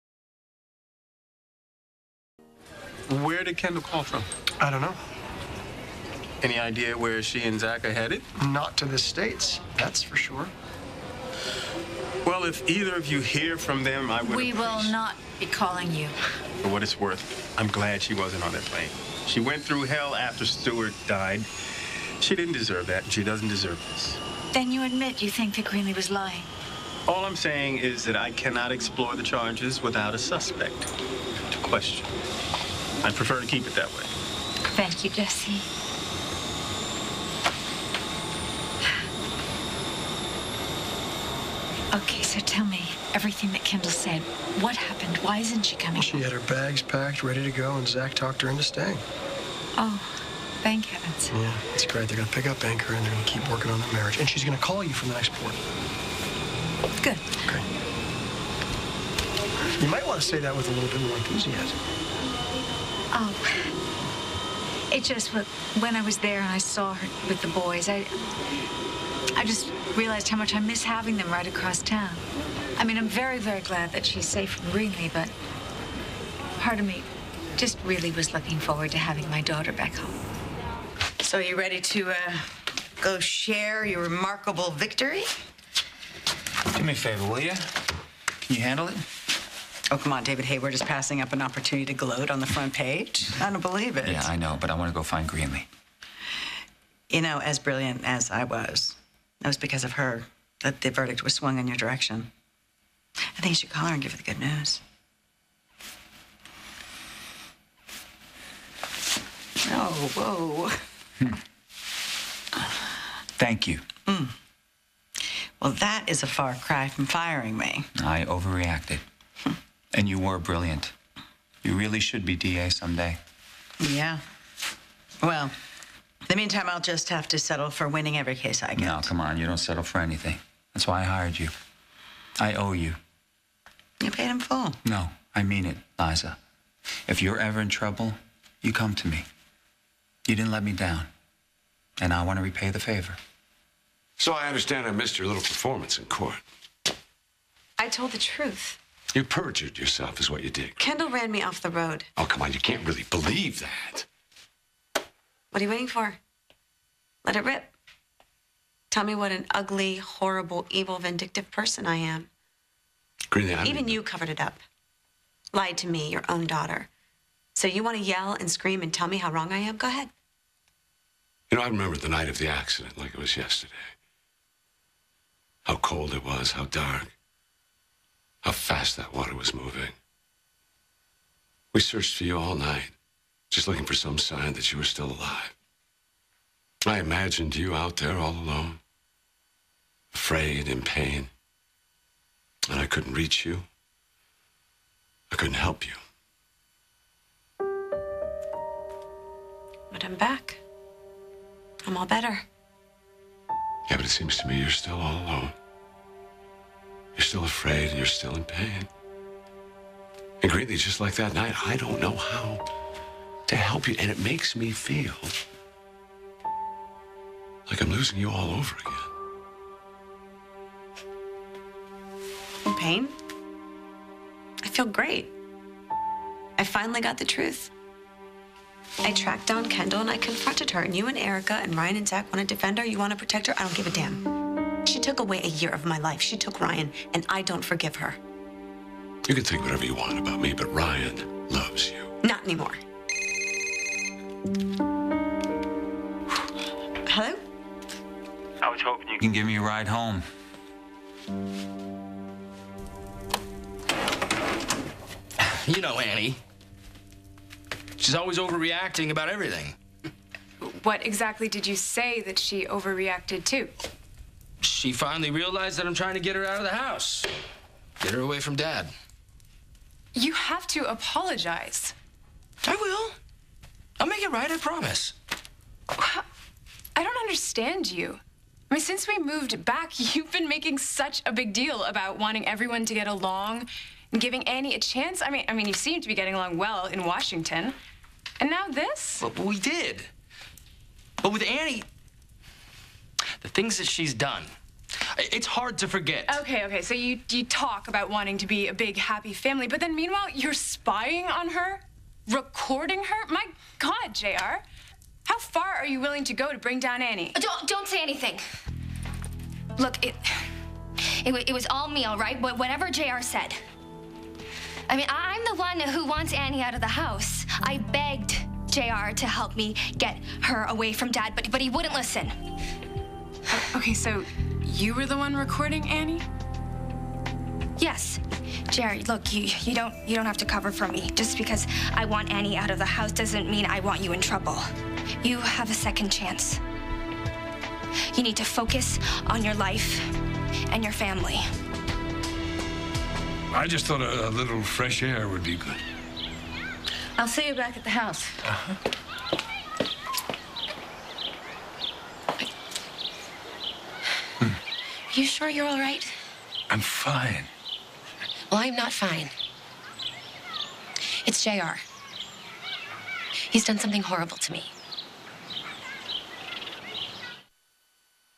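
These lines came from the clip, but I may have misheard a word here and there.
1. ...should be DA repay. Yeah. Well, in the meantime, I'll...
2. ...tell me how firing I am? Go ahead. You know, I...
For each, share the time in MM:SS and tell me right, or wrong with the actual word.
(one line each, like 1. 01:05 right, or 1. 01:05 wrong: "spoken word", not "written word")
1. 02:01 wrong: "someday", not "repay"
2. 02:48 wrong: "wrong", not "firing".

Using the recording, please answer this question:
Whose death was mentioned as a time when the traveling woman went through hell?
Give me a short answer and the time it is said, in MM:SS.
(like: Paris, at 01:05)
Stuart, at 00:20.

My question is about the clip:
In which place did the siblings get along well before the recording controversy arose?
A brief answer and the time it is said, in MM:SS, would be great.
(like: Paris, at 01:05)
Washington, at 04:47.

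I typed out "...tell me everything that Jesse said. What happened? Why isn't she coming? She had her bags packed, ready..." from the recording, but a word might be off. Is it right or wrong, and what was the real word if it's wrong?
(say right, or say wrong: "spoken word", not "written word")
wrong: "Kendall", not "Jesse".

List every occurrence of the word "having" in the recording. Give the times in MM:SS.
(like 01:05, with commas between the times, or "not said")
01:10, 01:18.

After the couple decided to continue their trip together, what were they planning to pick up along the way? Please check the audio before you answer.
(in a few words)
Anchor.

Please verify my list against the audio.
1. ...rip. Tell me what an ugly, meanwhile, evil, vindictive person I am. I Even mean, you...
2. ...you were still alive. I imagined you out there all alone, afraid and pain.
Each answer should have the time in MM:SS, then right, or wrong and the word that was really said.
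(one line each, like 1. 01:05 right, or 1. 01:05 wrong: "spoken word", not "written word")
1. 02:37 wrong: "horrible", not "meanwhile"
2. 03:04 right.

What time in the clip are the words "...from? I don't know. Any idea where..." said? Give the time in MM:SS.
00:04.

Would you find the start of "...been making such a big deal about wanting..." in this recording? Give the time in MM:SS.
04:40.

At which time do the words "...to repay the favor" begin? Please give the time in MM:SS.
02:22.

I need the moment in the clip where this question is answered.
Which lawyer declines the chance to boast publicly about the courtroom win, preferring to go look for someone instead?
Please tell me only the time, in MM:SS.
01:30.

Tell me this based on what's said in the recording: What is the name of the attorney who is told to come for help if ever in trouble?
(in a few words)
Liza.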